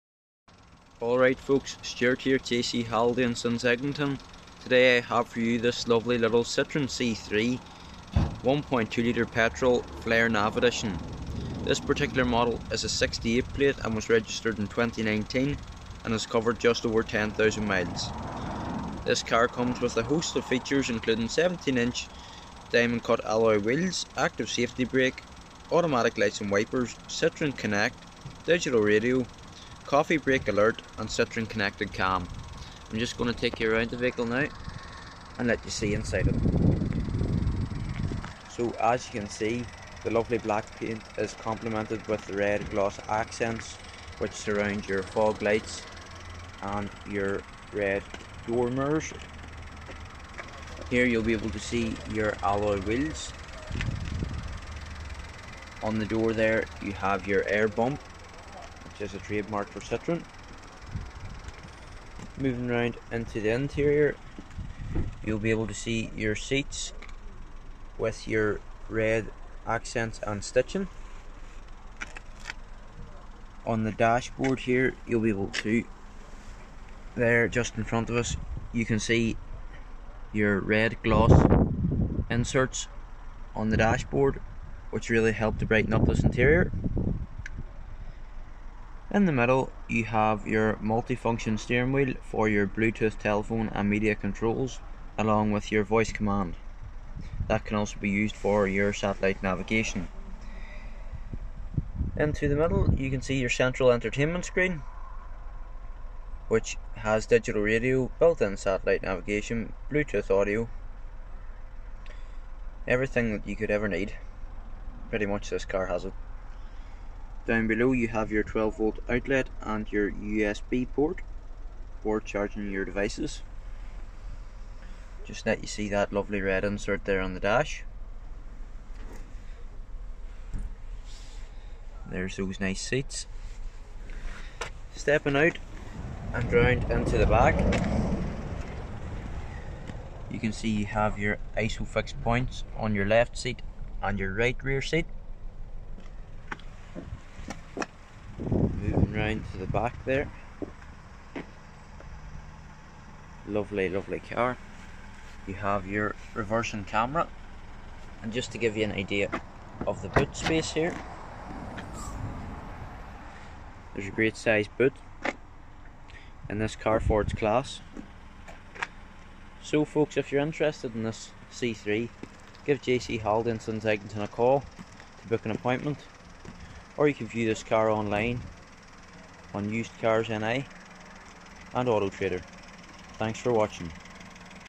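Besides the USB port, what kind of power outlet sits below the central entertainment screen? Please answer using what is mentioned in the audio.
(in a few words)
12 volt.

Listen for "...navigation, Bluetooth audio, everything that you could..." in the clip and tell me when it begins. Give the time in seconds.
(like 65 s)
109 s.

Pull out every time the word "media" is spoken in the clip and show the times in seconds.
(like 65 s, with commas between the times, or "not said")
93 s.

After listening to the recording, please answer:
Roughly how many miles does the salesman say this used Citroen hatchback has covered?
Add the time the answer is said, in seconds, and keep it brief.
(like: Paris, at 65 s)
10,000, at 17 s.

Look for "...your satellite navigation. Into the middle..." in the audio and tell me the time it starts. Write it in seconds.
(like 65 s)
98 s.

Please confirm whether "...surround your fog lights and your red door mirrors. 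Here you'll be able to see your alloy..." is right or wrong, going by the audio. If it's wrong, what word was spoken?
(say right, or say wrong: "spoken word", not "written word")
right.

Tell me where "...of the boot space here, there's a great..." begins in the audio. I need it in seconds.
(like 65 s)
159 s.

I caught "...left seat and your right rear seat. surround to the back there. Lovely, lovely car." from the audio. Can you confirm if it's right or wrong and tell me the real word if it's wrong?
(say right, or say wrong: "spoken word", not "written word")
wrong: "round", not "surround".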